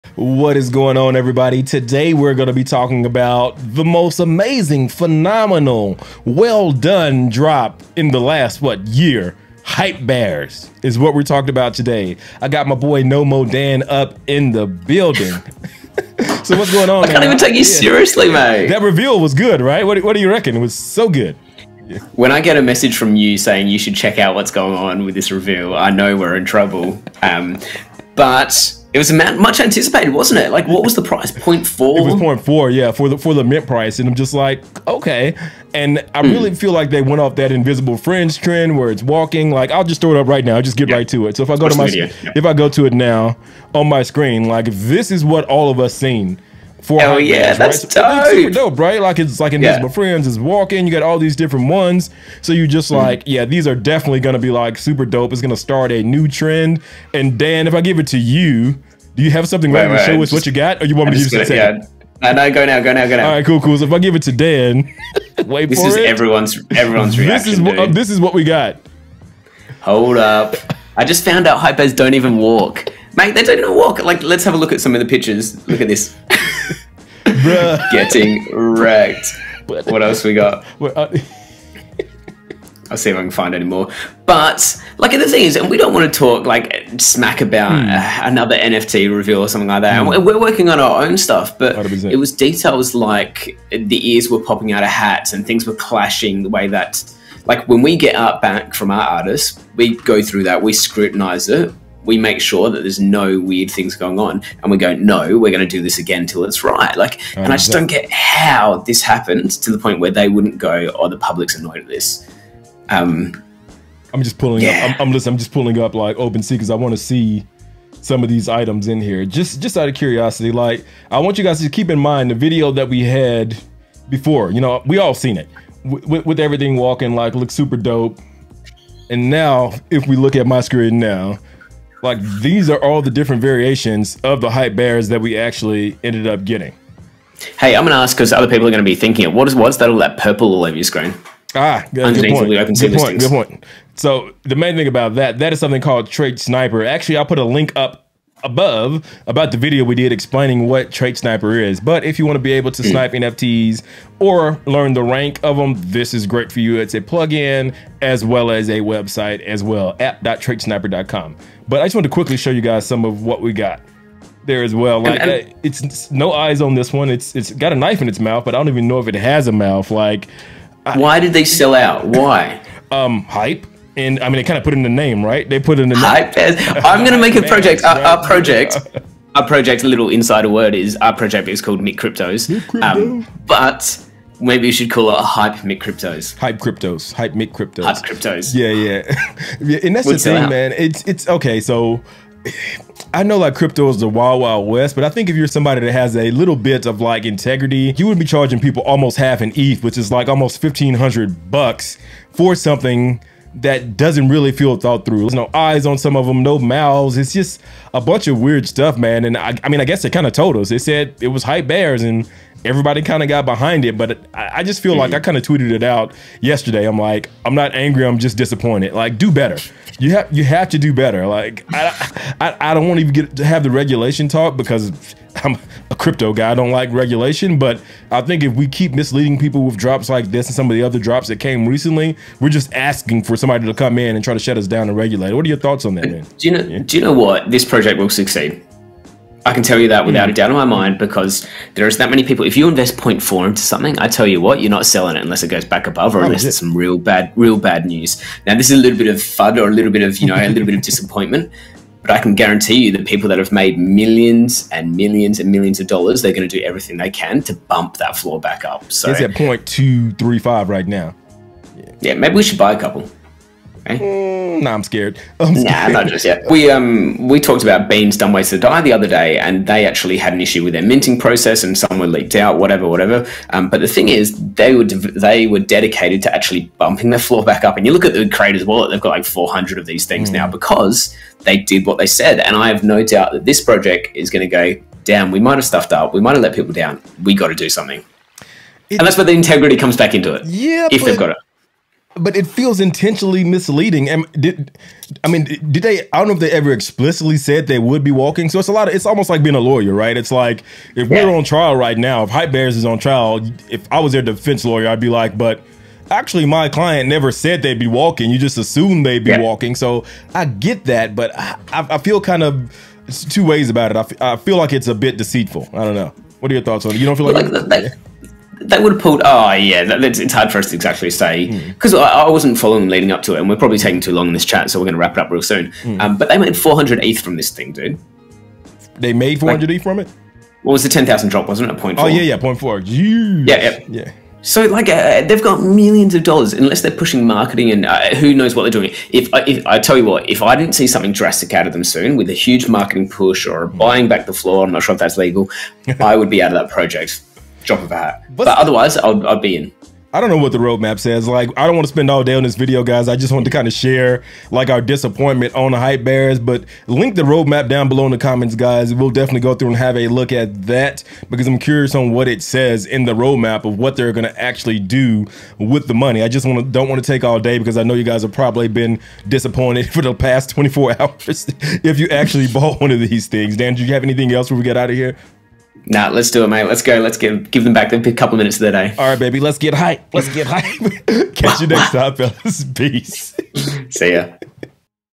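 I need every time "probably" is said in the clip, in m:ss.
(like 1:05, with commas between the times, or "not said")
5:23, 6:08.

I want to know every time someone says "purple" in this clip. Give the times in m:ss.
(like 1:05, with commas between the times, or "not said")
2:20.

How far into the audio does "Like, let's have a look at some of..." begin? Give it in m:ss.
1:14.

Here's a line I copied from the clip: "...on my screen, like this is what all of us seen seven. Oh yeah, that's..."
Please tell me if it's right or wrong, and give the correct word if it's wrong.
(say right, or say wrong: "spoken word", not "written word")
wrong: "four", not "seven".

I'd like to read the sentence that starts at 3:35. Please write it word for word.
kind of tweeted it out yesterday.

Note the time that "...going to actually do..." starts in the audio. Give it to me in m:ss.
6:04.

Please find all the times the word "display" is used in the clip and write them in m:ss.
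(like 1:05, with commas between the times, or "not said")
not said.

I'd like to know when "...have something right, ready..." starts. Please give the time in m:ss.
0:59.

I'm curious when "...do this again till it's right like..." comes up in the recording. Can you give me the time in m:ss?
1:45.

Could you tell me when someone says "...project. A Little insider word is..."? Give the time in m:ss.
2:59.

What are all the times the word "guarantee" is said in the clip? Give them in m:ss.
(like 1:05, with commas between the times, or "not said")
4:12.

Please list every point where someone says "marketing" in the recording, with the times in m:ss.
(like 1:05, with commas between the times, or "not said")
5:37, 5:42.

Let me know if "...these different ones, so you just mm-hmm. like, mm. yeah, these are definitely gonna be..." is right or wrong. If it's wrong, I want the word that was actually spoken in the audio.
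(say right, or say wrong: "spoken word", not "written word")
right.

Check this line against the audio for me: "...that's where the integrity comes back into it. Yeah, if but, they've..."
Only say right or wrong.
right.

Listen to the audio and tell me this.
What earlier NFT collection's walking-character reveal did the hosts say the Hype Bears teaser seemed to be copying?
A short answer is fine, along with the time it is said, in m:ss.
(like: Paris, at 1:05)
Invisible Friends, at 0:37.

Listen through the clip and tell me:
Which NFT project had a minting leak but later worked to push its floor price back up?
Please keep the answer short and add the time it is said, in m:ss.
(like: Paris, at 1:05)
Beans Dumb Ways to Die, at 4:27.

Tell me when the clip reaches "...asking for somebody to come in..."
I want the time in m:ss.
3:52.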